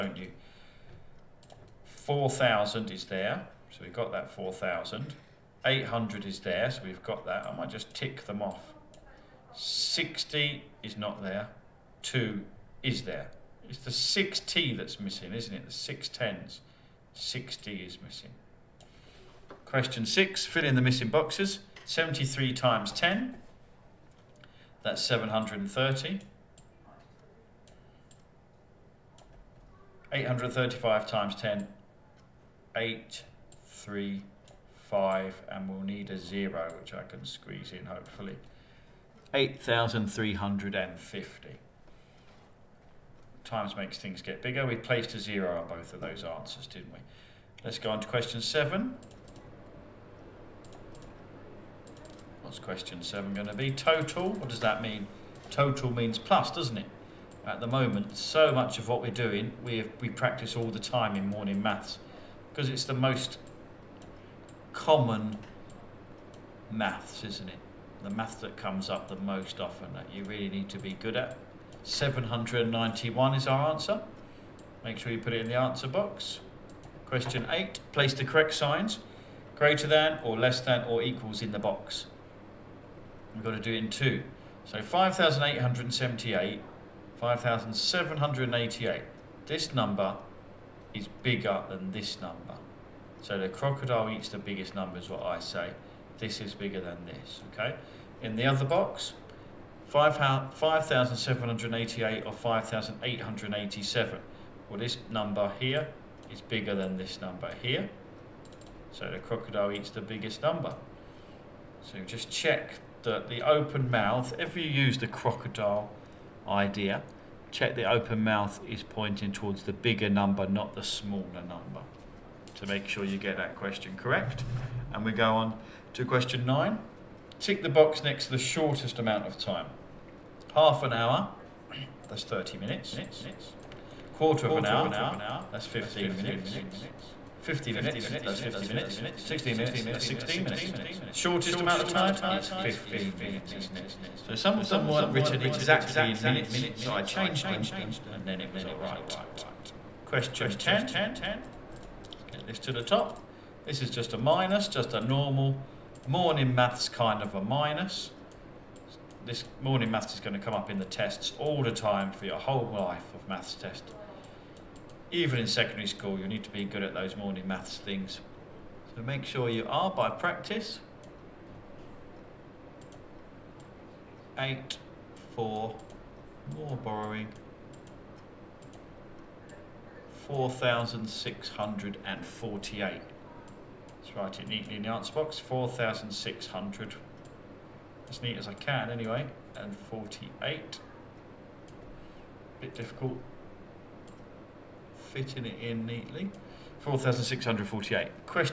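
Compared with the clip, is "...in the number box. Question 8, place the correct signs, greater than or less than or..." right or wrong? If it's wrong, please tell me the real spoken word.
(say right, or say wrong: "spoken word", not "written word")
wrong: "answer", not "number".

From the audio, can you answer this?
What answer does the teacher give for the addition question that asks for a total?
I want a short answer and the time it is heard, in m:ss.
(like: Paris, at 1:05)
791, at 1:11.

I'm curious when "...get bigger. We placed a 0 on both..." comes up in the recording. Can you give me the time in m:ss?
0:44.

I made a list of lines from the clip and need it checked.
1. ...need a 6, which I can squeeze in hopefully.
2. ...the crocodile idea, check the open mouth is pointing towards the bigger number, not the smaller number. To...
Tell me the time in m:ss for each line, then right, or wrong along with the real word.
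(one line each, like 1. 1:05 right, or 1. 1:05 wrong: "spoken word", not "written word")
1. 0:35 wrong: "0", not "6"
2. 1:54 right.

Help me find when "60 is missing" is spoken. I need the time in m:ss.
0:17.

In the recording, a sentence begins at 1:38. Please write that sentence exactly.
In the other box, 5,788 or 5,887.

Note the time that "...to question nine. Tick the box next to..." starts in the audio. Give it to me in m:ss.
2:05.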